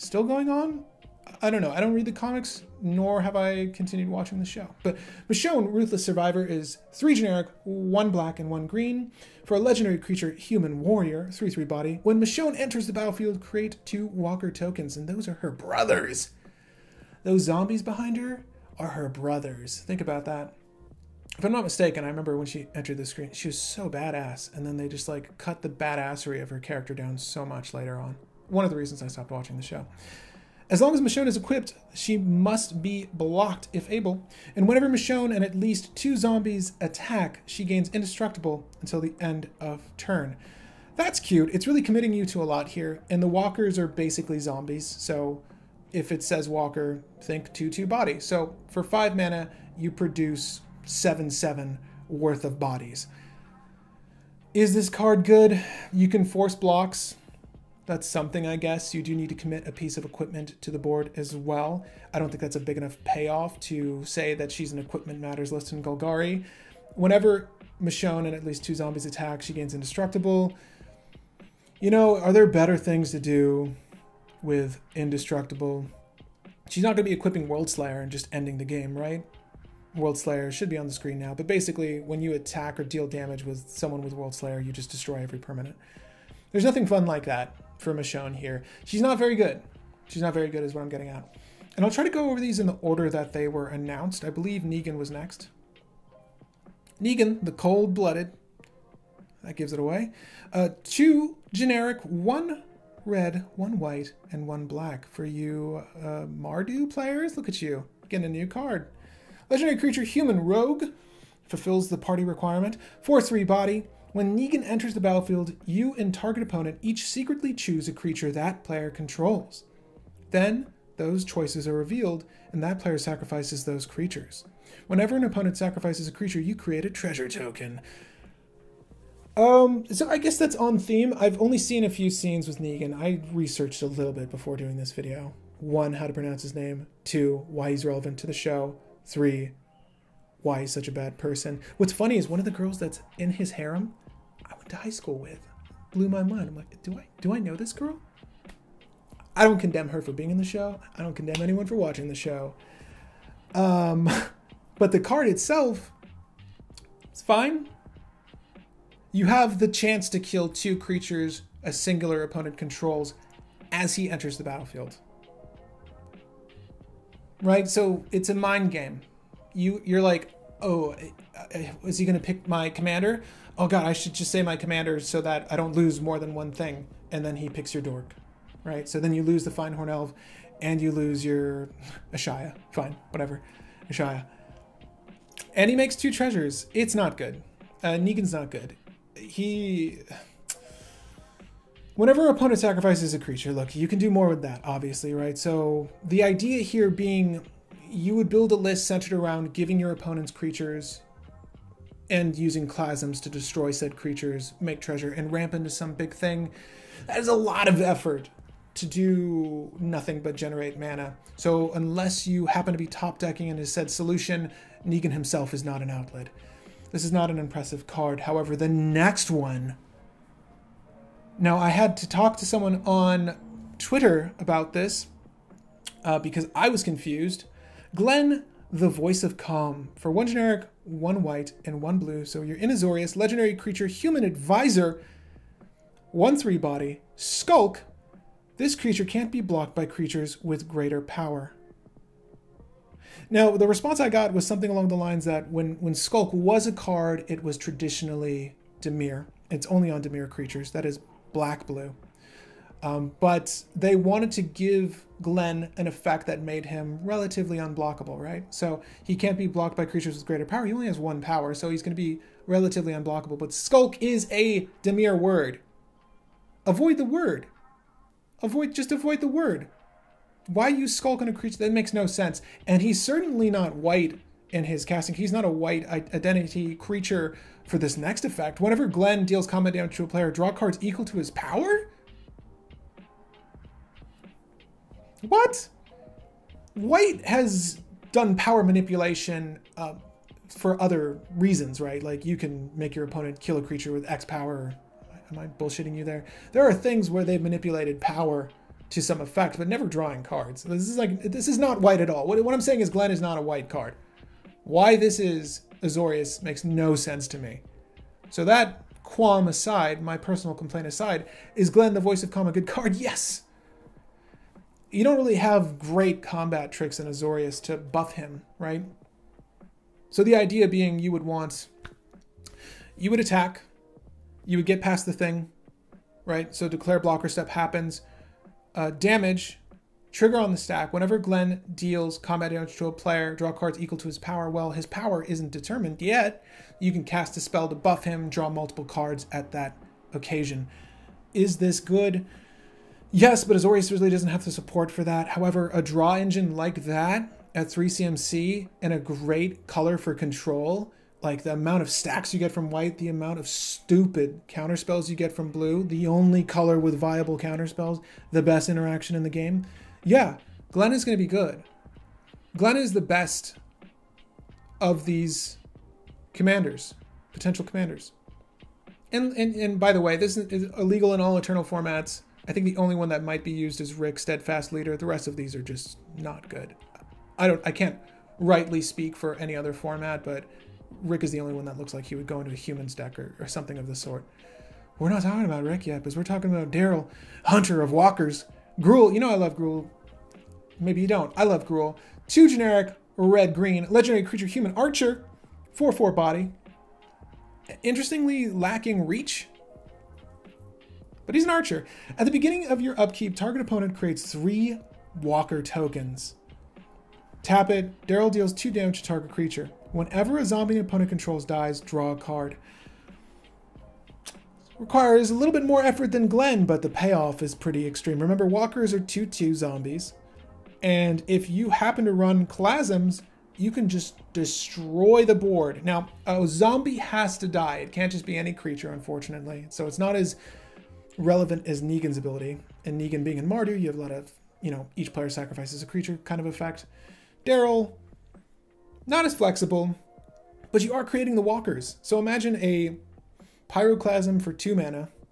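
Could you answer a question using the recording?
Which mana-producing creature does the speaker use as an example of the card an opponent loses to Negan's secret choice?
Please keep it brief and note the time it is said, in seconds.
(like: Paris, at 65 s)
Fyndhorn Elf, at 179 s.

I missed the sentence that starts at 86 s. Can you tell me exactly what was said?
There's nothing fun like that for Michonne here.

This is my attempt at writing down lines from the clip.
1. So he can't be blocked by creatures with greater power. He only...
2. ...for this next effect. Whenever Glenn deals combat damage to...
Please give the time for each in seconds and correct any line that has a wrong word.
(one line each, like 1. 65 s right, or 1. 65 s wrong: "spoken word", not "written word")
1. 258 s right
2. 277 s right.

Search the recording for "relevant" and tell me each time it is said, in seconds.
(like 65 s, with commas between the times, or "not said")
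137 s, 431 s.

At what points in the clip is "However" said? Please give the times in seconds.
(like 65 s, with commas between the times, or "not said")
218 s, 345 s.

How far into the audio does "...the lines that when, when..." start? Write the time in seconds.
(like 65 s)
244 s.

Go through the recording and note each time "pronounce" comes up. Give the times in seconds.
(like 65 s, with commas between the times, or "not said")
136 s.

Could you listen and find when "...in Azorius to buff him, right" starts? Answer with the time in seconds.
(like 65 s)
316 s.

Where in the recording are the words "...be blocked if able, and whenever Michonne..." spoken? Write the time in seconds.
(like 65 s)
32 s.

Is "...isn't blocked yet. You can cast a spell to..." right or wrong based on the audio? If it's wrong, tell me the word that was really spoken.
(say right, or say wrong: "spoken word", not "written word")
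wrong: "determined", not "blocked".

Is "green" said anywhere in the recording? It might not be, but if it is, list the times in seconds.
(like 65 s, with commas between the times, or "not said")
8 s, 393 s.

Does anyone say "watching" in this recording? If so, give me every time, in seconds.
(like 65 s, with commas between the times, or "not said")
4 s, 29 s, 151 s.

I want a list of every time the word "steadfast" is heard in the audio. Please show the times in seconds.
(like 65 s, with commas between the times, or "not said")
374 s.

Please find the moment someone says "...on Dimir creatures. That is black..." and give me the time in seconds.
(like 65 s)
249 s.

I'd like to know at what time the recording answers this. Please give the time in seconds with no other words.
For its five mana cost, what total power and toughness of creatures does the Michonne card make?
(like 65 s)
50 s.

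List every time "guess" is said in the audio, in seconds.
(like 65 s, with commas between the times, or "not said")
58 s, 130 s.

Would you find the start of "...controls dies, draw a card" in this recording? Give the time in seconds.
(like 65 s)
411 s.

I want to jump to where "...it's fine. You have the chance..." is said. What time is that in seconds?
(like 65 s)
157 s.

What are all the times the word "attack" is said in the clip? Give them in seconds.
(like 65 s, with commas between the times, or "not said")
36 s, 69 s, 82 s, 323 s.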